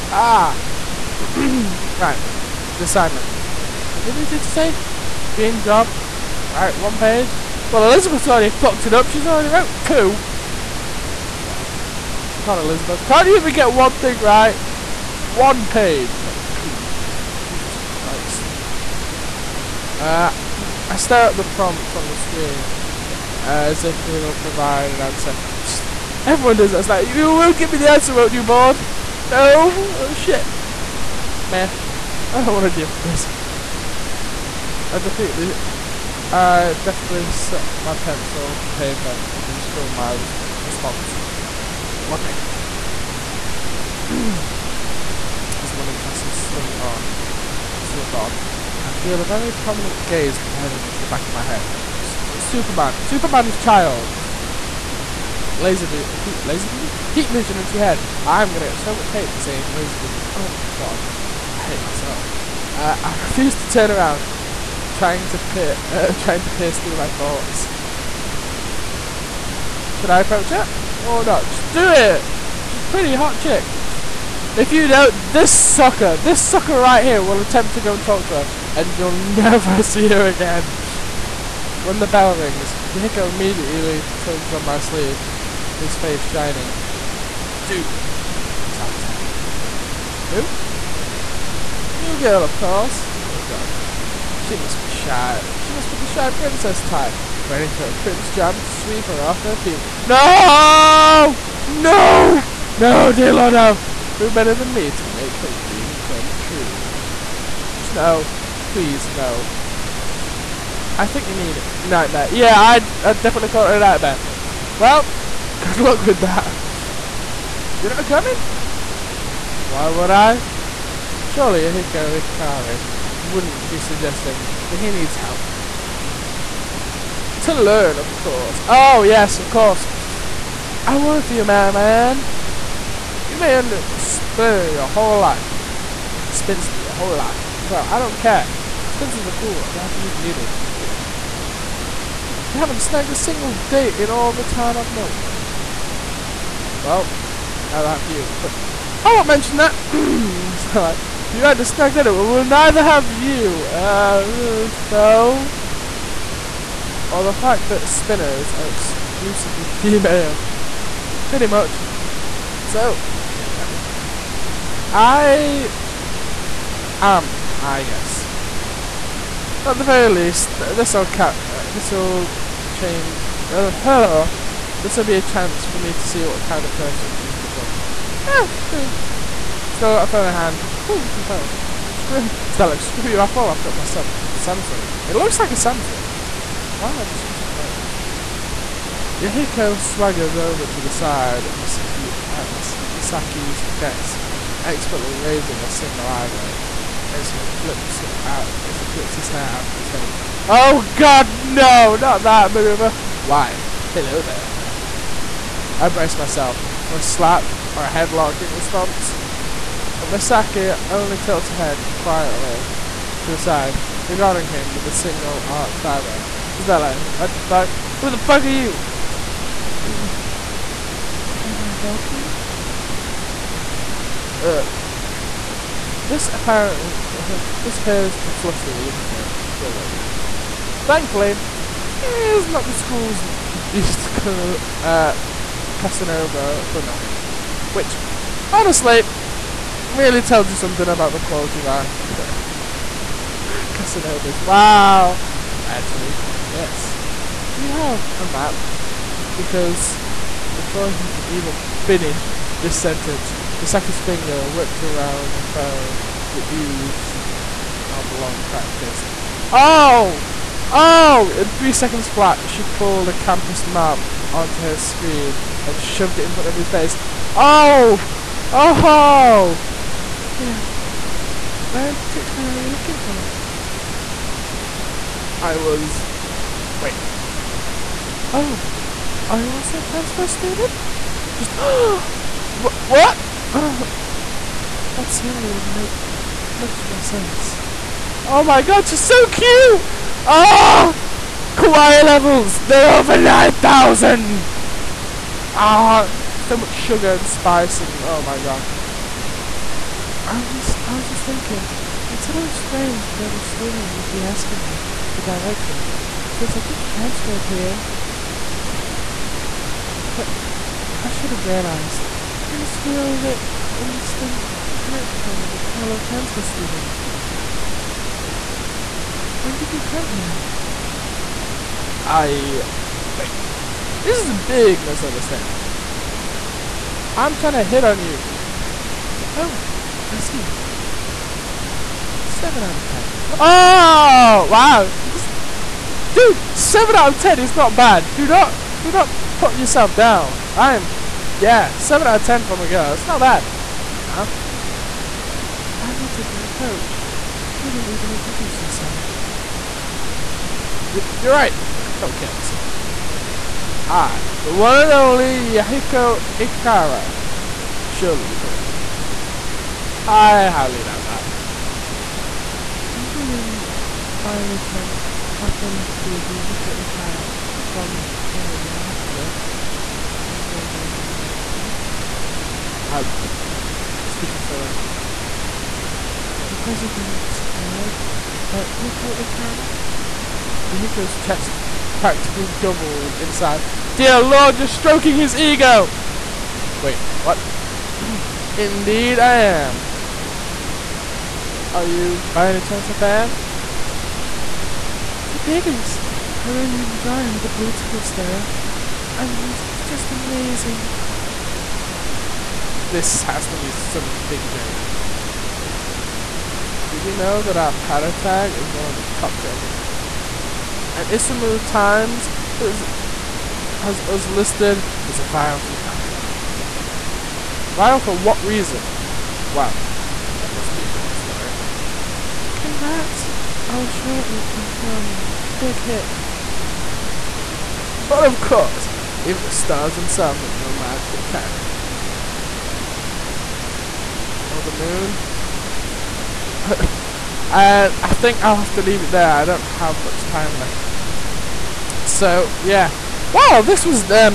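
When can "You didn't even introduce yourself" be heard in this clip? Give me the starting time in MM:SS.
05:47.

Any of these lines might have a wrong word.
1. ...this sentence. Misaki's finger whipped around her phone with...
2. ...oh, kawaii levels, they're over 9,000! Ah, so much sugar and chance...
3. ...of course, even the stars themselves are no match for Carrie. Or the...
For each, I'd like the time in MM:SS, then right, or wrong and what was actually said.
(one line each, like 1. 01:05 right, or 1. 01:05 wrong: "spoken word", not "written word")
1. 04:12 right
2. 04:50 wrong: "spice", not "chance"
3. 07:08 right.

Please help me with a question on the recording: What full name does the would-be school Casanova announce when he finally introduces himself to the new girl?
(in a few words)
Yahiko Ikara.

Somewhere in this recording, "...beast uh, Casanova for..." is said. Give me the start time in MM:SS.
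03:53.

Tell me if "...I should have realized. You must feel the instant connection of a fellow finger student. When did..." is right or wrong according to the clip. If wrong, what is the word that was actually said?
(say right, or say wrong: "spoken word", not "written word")
wrong: "transfer", not "finger".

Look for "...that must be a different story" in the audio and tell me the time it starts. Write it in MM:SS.
07:00.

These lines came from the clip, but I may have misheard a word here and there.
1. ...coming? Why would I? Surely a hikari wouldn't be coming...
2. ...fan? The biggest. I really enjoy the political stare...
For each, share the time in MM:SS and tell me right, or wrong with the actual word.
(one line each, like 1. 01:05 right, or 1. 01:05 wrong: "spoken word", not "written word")
1. 01:58 wrong: "suggesting", not "coming"
2. 06:32 right.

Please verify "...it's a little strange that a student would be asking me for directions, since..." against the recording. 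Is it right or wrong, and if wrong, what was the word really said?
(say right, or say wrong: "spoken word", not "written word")
right.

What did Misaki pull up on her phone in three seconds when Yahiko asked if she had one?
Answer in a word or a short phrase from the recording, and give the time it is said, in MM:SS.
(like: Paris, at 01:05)
A campus map, at 04:23.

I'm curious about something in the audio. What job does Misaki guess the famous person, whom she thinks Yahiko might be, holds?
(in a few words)
The president's aide.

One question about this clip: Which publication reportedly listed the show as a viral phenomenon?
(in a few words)
Isamu Times.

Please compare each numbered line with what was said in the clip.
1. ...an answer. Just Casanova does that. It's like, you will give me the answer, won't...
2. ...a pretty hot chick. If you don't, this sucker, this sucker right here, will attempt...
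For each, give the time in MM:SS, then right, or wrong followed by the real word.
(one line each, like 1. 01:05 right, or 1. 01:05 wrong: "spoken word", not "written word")
1. 00:24 wrong: "Everyone", not "Casanova"
2. 01:12 right.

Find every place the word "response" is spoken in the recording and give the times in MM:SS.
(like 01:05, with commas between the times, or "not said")
00:40, 03:28.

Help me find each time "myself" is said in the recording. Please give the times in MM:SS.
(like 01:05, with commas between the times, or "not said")
01:01, 03:03, 03:26.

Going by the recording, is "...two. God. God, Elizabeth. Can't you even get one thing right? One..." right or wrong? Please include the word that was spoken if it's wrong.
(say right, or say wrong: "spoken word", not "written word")
right.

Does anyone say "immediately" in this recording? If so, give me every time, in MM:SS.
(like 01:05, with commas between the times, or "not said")
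01:23.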